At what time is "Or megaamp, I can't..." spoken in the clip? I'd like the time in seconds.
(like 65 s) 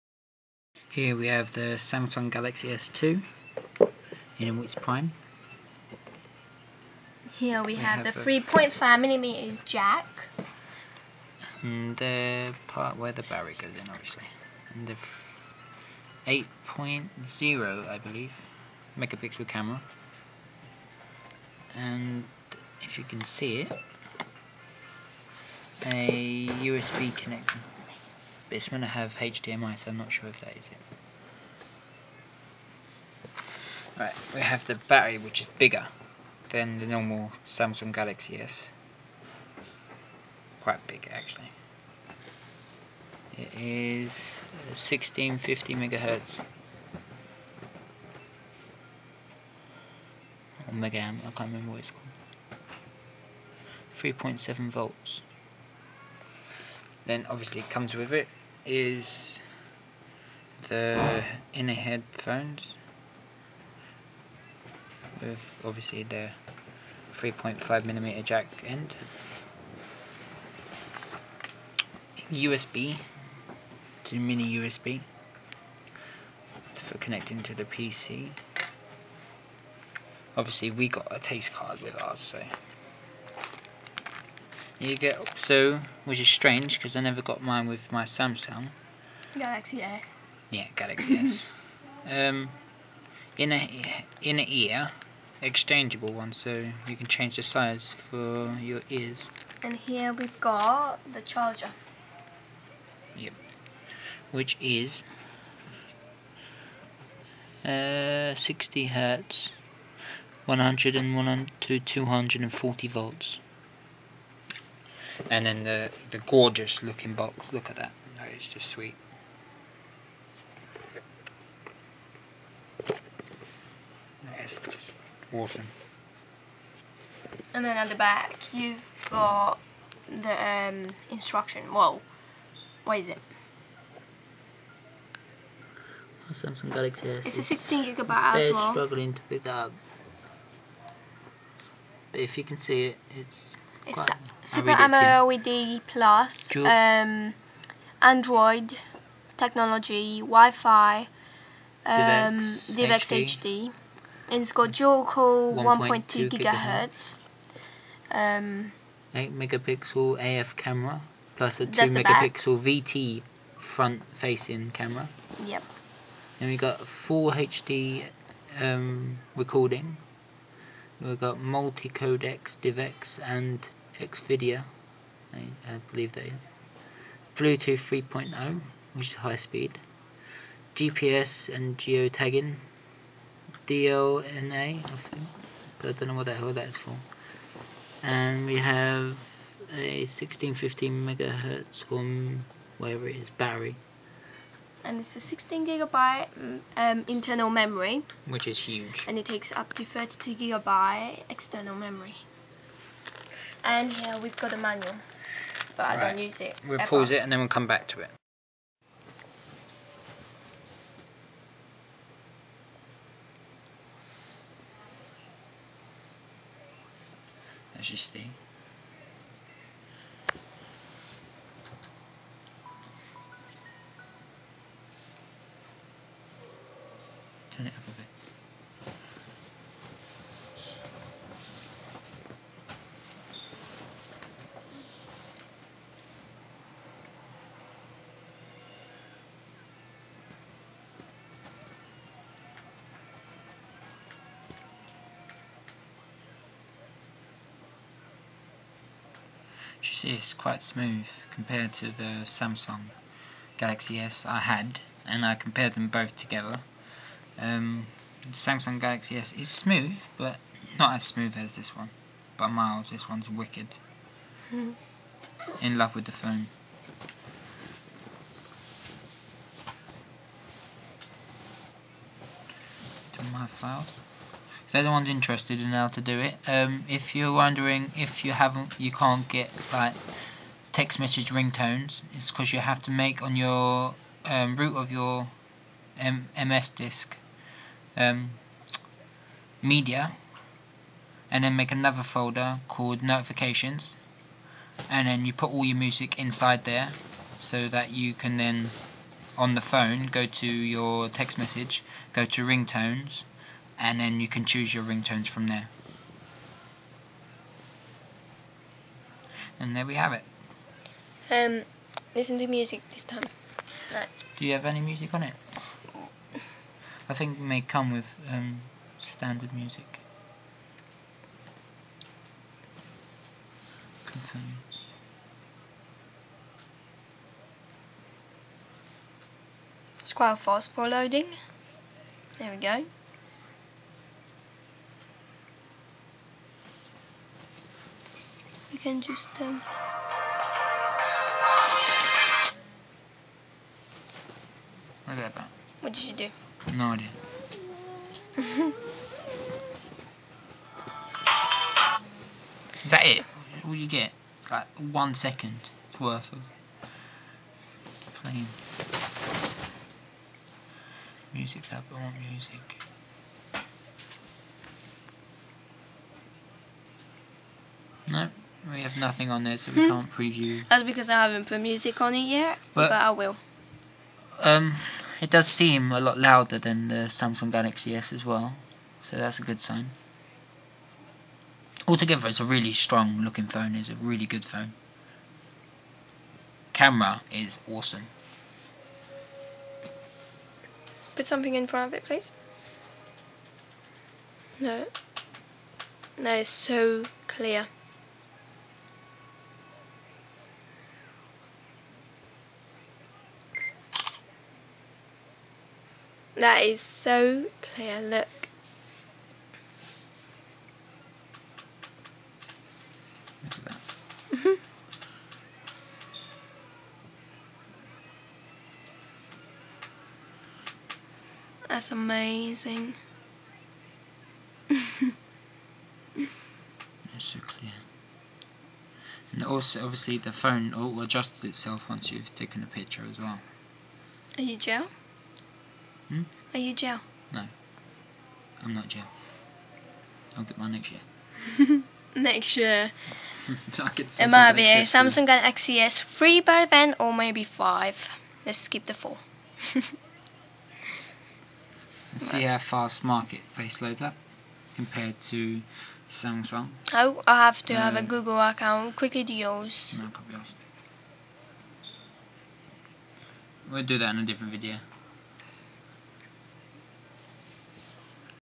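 50 s.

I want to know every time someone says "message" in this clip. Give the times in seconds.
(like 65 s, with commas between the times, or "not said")
280 s, 301 s.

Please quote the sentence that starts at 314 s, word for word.
do you have any music on it I think may come with um, standard music.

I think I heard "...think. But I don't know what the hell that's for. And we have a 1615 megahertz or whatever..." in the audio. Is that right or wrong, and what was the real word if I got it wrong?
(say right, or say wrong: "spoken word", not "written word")
right.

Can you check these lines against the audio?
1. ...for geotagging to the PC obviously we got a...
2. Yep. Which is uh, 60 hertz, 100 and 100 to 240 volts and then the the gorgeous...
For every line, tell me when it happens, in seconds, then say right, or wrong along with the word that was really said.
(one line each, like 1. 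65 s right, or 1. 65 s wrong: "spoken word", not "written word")
1. 76 s wrong: "connecting", not "geotagging"
2. 103 s right.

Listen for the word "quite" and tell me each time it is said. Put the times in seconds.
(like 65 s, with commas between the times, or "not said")
40 s, 250 s, 330 s.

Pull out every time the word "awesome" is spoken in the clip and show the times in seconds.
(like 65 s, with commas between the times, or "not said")
125 s, 387 s.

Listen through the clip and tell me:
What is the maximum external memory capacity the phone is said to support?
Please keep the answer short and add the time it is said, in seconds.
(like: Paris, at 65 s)
32 gigabyte, at 199 s.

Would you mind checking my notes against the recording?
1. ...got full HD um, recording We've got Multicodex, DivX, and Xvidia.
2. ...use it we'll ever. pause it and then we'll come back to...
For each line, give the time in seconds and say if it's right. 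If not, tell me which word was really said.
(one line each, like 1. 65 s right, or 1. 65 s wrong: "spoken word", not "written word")
1. 166 s right
2. 206 s right.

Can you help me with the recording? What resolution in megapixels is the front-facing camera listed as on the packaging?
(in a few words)
2 megapixel.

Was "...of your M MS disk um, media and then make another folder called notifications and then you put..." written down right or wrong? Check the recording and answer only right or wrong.
right.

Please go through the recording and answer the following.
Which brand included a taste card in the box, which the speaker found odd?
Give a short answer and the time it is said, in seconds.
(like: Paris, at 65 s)
Oxo, at 85 s.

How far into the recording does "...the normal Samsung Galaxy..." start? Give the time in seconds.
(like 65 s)
36 s.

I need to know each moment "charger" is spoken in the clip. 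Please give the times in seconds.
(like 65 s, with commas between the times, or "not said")
101 s.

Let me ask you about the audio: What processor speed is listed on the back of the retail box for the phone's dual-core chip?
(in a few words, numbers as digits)
1.2 gigahertz.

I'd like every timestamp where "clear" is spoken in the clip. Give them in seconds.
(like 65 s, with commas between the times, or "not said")
397 s, 407 s, 427 s.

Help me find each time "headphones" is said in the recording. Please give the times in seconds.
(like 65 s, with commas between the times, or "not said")
61 s.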